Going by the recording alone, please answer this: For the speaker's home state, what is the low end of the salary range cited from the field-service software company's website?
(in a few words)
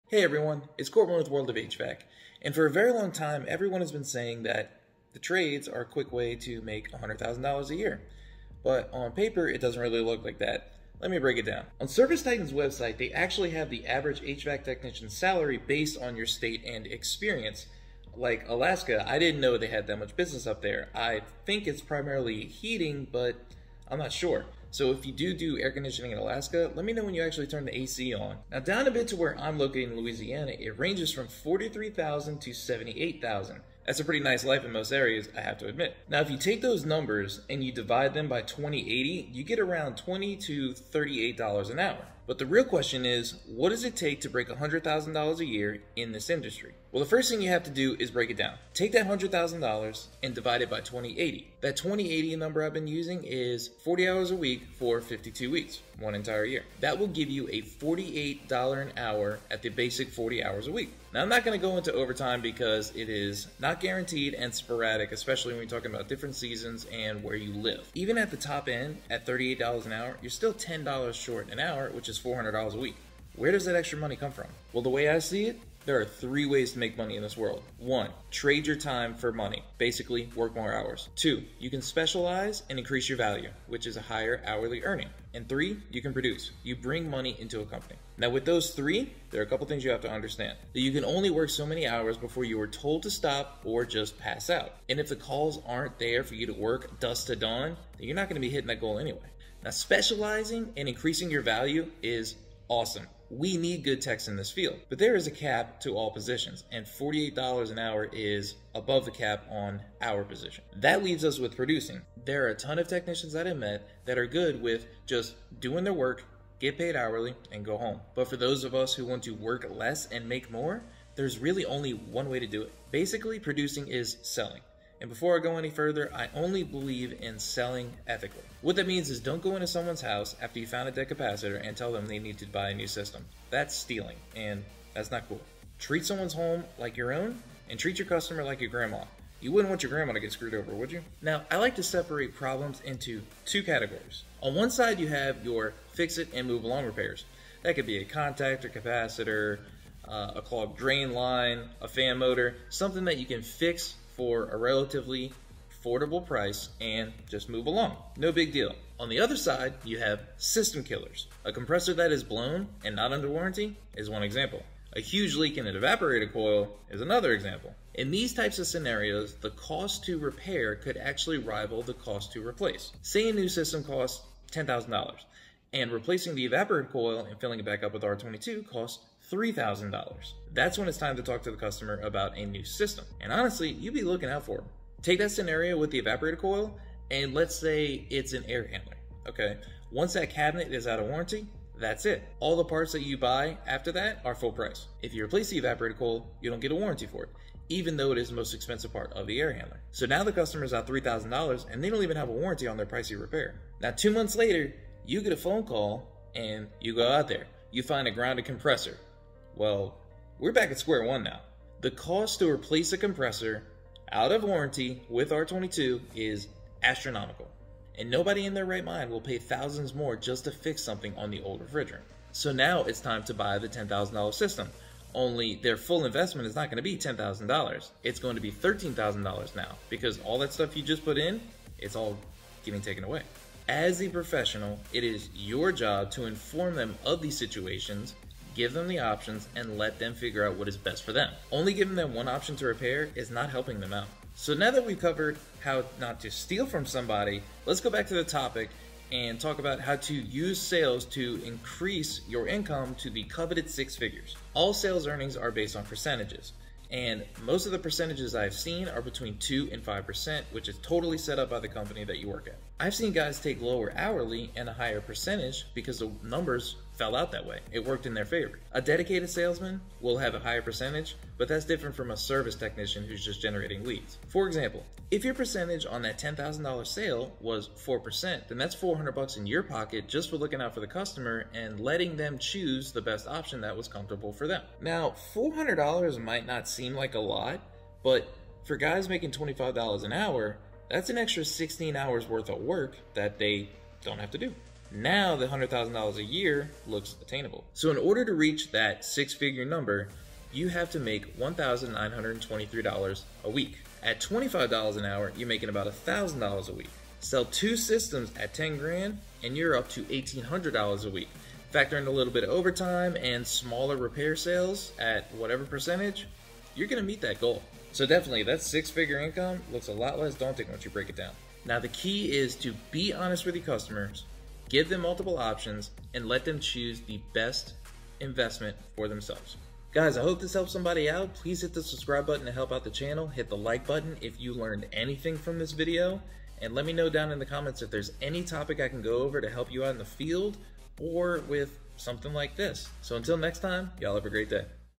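$43,000.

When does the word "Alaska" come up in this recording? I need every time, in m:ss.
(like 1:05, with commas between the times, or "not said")
0:18, 0:26.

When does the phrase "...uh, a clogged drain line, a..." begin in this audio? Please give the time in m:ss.
2:30.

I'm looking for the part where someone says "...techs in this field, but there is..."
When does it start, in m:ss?
1:43.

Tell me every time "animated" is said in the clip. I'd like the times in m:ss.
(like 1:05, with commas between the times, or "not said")
not said.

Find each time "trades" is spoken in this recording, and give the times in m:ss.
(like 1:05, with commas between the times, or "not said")
0:05, 1:18.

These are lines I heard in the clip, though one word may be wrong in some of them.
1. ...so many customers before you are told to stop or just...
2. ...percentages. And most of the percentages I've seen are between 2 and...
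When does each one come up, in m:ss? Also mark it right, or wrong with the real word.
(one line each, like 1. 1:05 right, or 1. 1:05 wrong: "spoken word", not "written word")
1. 1:31 wrong: "hours", not "customers"
2. 4:15 right.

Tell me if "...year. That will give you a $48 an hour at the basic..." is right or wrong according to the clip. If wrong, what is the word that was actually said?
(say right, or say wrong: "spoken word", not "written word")
right.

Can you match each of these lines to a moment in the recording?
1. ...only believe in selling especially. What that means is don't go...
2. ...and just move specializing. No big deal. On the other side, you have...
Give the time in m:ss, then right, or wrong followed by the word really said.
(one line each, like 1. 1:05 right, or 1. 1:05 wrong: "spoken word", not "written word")
1. 2:06 wrong: "ethically", not "especially"
2. 2:36 wrong: "along", not "specializing".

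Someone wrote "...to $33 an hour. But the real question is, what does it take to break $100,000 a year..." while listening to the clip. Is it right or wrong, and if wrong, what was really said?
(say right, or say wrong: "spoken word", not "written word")
wrong: "38", not "33".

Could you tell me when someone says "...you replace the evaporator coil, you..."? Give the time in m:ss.
3:15.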